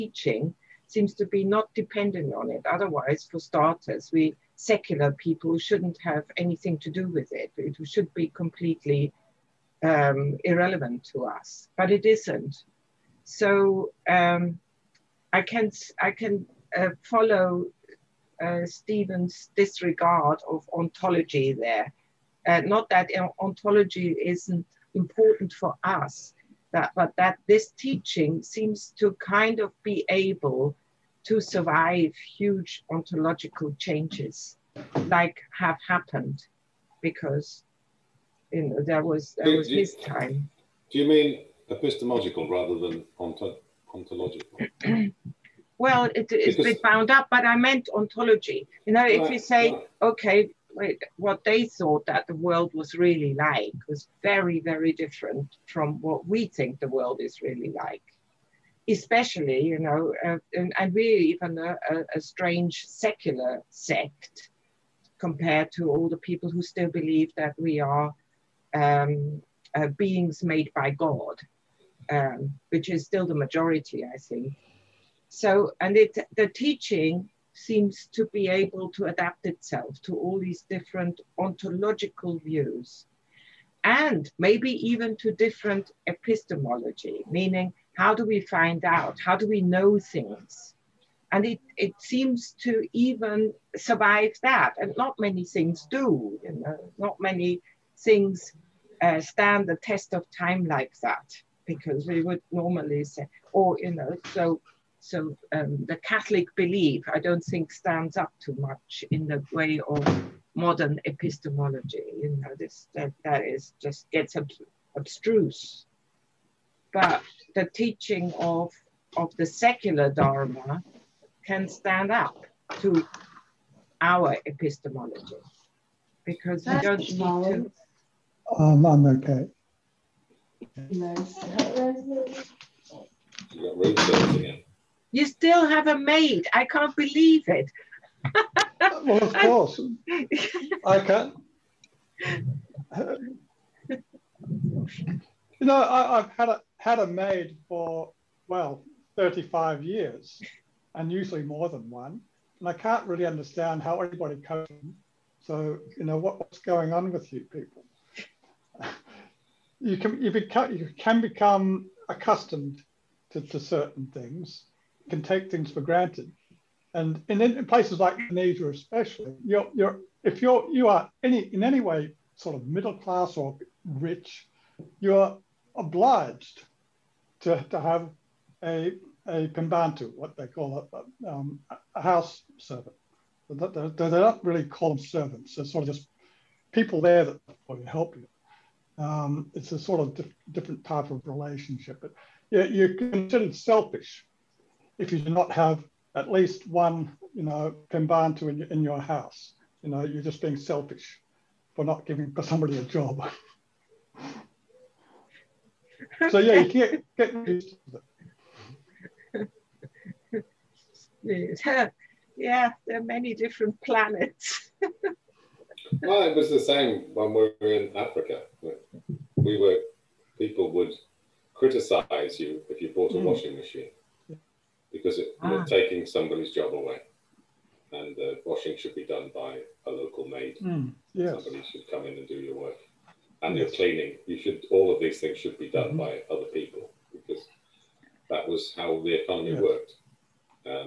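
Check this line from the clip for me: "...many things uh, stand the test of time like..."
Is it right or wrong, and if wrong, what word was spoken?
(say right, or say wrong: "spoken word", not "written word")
right.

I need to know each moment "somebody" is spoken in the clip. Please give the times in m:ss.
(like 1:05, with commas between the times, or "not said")
3:22, 3:46, 3:51.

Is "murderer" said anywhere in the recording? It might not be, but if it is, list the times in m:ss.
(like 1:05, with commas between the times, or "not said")
not said.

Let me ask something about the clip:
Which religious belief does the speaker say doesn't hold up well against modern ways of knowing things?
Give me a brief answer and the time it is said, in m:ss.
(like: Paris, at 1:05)
Catholic belief, at 1:45.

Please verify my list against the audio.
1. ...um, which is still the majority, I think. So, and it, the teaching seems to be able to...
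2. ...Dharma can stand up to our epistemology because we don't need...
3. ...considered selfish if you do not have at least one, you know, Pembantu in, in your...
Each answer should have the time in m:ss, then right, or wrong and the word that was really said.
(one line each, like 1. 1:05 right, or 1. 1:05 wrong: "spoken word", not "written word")
1. 1:12 right
2. 2:00 right
3. 3:12 right.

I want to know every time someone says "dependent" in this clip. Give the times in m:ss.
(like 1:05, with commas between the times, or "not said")
0:01.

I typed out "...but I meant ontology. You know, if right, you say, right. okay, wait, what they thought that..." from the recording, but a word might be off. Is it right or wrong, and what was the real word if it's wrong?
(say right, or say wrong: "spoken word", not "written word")
right.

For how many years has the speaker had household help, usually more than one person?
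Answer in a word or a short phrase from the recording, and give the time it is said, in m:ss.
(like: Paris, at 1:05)
35, at 2:29.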